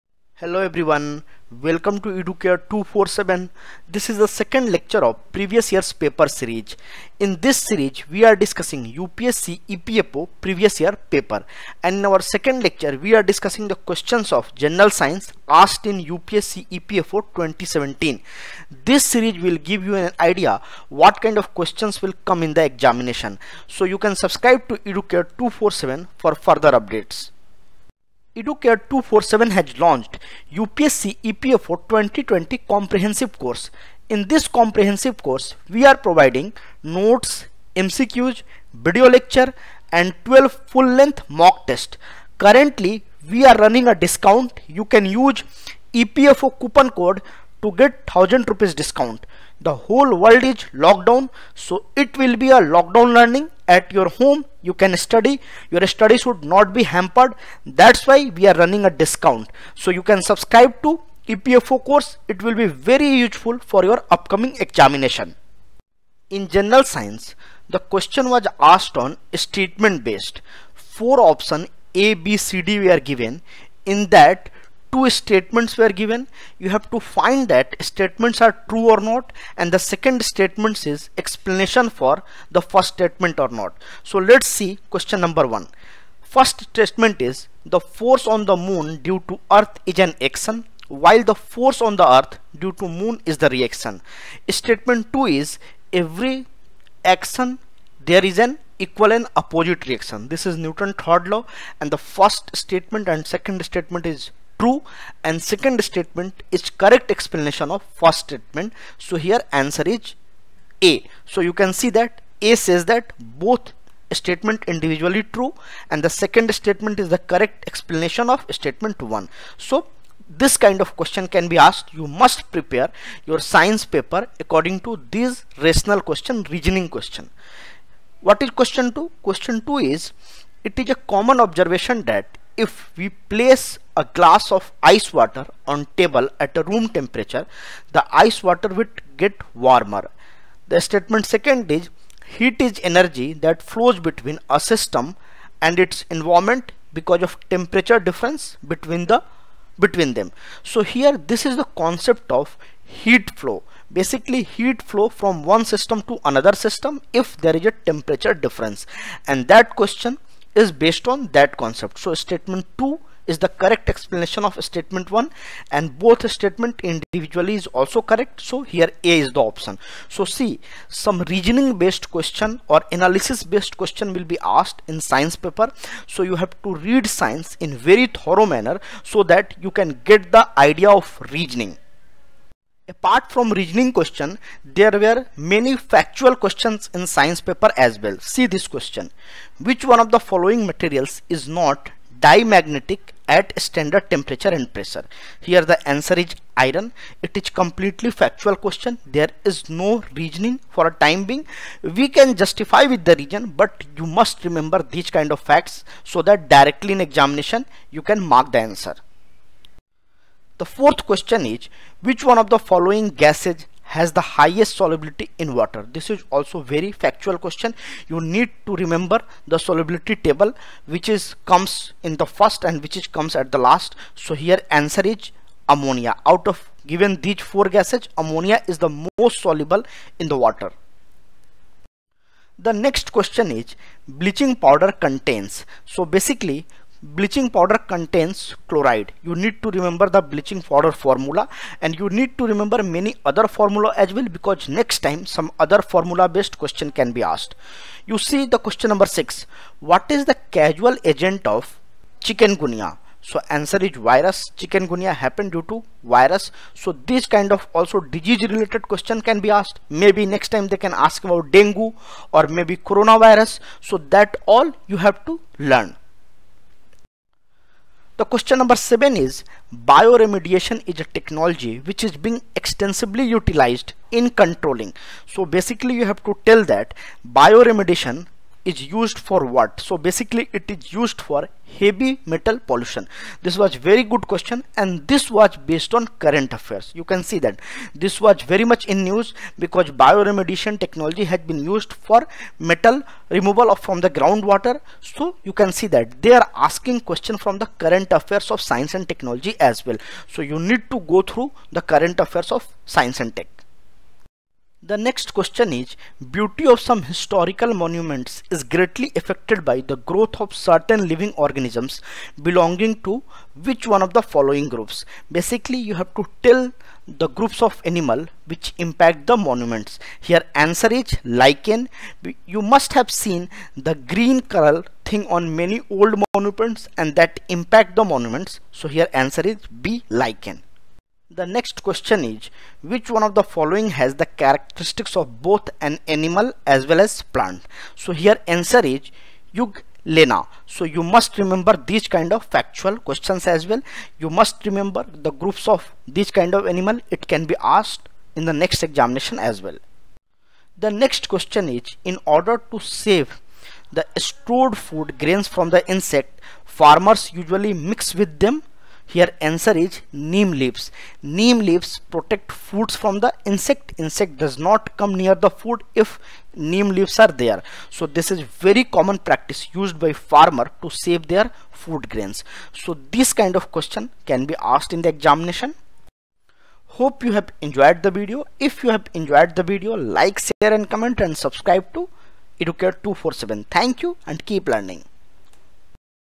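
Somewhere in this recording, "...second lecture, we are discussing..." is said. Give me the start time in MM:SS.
00:12.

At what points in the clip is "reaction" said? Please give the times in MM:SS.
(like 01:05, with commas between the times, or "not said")
01:33, 01:39.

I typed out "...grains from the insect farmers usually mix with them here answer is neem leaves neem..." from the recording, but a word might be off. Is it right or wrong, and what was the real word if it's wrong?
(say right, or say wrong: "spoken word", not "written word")
right.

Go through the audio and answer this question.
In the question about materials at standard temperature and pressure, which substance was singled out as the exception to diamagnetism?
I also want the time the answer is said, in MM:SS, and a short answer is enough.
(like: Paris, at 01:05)
Iron, at 03:16.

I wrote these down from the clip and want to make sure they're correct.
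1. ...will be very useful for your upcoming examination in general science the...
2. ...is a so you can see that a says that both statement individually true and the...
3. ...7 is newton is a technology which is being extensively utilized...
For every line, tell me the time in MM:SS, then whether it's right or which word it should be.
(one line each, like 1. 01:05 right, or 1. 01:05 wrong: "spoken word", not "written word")
1. 01:02 right
2. 01:49 right
3. 04:28 wrong: "bioremediation", not "newton".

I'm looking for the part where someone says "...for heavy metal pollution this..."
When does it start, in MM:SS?
04:41.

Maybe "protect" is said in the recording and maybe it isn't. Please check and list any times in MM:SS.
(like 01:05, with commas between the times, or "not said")
06:02.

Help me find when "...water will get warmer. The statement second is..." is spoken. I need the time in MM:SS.
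02:18.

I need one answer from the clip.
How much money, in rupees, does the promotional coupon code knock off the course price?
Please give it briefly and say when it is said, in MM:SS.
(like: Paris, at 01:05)
1000 rupees, at 00:48.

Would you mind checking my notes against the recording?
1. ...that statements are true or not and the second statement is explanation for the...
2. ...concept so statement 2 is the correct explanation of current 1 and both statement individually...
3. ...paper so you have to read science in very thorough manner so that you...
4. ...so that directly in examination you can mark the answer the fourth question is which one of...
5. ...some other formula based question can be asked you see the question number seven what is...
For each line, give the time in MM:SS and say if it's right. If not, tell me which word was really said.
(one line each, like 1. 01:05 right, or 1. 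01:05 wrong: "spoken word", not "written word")
1. 01:17 right
2. 02:41 wrong: "statement", not "current"
3. 02:55 right
4. 03:26 right
5. 04:05 wrong: "six", not "seven".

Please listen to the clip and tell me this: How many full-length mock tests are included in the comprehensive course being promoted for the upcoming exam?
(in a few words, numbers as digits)
12.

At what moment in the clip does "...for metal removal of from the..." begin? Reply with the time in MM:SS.
04:51.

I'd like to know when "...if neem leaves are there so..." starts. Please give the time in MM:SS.
06:06.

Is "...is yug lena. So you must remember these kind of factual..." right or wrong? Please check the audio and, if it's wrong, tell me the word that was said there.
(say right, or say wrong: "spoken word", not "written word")
right.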